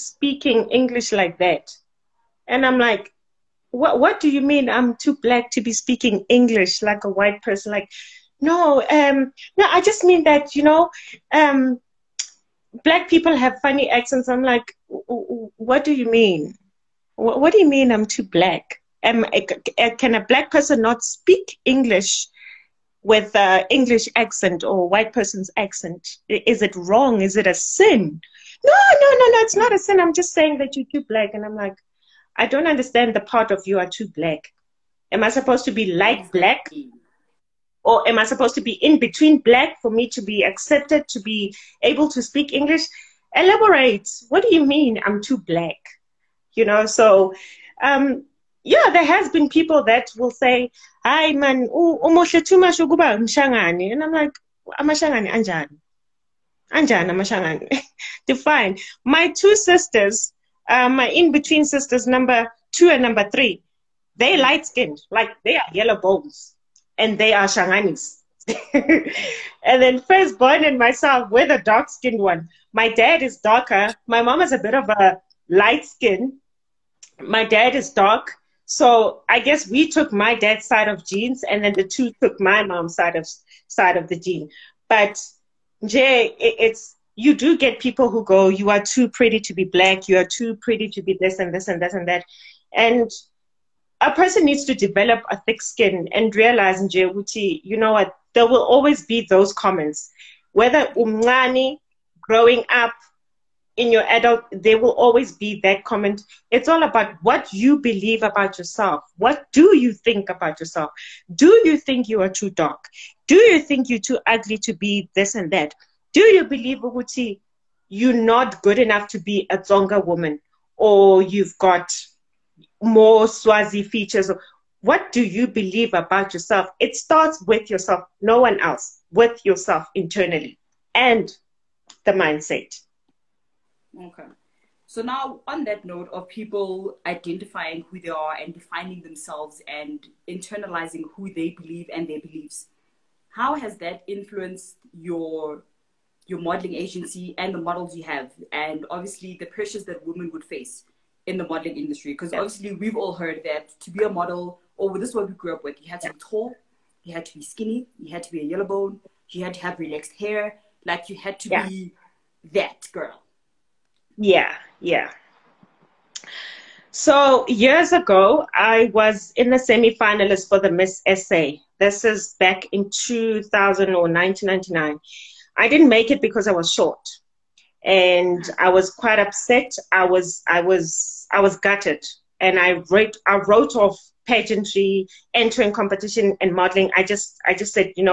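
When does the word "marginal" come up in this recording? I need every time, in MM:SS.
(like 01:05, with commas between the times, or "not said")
not said.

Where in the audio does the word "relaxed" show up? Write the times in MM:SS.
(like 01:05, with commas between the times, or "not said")
02:39.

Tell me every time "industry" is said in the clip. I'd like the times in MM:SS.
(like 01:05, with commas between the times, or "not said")
02:31.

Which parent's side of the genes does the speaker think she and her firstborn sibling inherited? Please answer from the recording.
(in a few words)
Dad's side.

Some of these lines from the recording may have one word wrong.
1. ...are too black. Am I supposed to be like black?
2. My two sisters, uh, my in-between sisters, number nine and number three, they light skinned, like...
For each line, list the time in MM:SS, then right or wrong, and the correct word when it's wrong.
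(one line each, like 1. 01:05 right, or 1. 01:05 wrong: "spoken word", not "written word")
1. 00:33 right
2. 00:59 wrong: "two", not "nine".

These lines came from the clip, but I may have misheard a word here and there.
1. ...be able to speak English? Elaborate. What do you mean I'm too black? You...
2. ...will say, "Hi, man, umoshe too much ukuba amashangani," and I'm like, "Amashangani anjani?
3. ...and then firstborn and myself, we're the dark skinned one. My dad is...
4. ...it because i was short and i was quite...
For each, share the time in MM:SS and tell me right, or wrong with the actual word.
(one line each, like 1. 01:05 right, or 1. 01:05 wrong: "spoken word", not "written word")
1. 00:41 right
2. 00:50 wrong: "mshangani", not "amashangani"
3. 01:08 right
4. 02:56 right.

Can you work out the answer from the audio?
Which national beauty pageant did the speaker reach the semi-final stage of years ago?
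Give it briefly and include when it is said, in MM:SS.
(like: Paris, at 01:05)
Miss SA, at 02:50.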